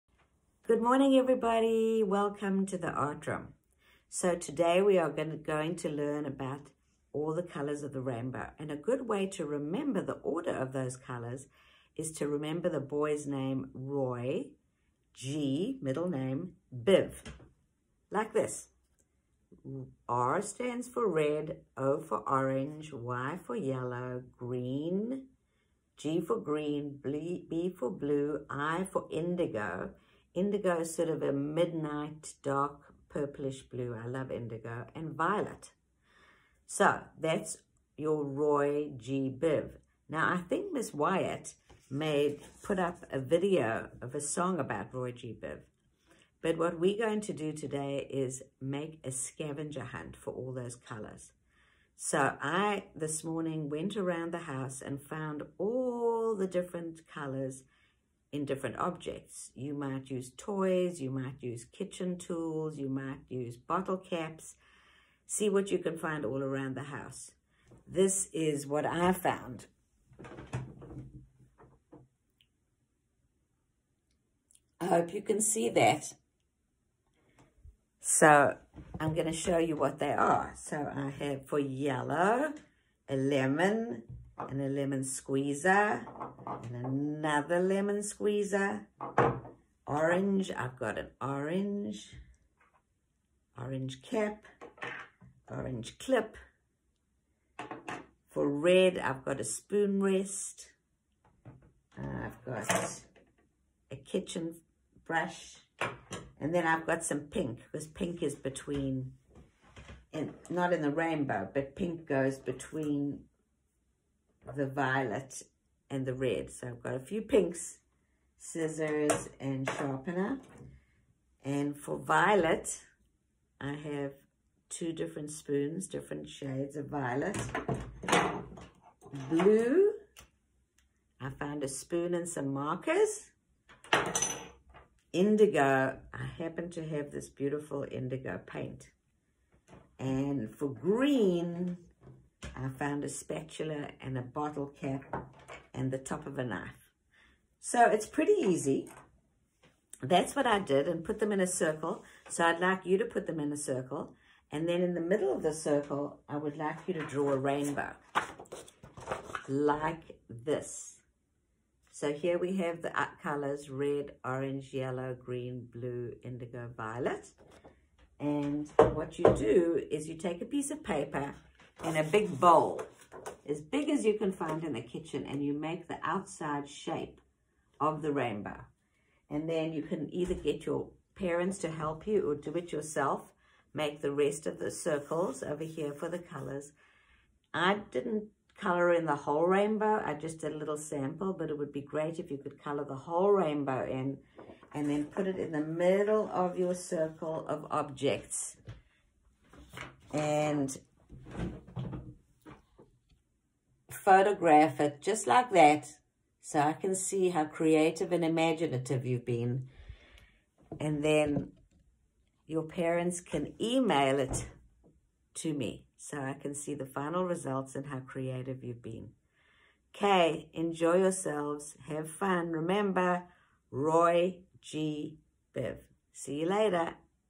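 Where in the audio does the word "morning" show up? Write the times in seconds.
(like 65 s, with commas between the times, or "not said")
0 s, 53 s.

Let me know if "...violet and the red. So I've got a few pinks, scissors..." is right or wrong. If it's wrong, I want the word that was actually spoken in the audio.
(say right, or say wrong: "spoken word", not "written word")
right.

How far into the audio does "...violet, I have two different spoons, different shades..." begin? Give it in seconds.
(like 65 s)
121 s.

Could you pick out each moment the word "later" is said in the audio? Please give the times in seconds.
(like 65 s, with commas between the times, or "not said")
226 s.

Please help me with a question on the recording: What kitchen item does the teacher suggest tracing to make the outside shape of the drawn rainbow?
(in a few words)
A big bowl.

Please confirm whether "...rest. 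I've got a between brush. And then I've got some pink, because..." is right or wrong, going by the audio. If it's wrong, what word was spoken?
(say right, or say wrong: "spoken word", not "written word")
wrong: "kitchen", not "between".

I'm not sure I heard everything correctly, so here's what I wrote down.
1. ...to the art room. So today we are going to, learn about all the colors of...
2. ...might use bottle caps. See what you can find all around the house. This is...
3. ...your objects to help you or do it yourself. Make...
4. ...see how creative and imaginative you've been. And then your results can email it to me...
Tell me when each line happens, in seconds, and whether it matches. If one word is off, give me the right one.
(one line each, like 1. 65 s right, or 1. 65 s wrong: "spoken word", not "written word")
1. 2 s right
2. 62 s right
3. 180 s wrong: "parents", not "objects"
4. 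206 s wrong: "parents", not "results".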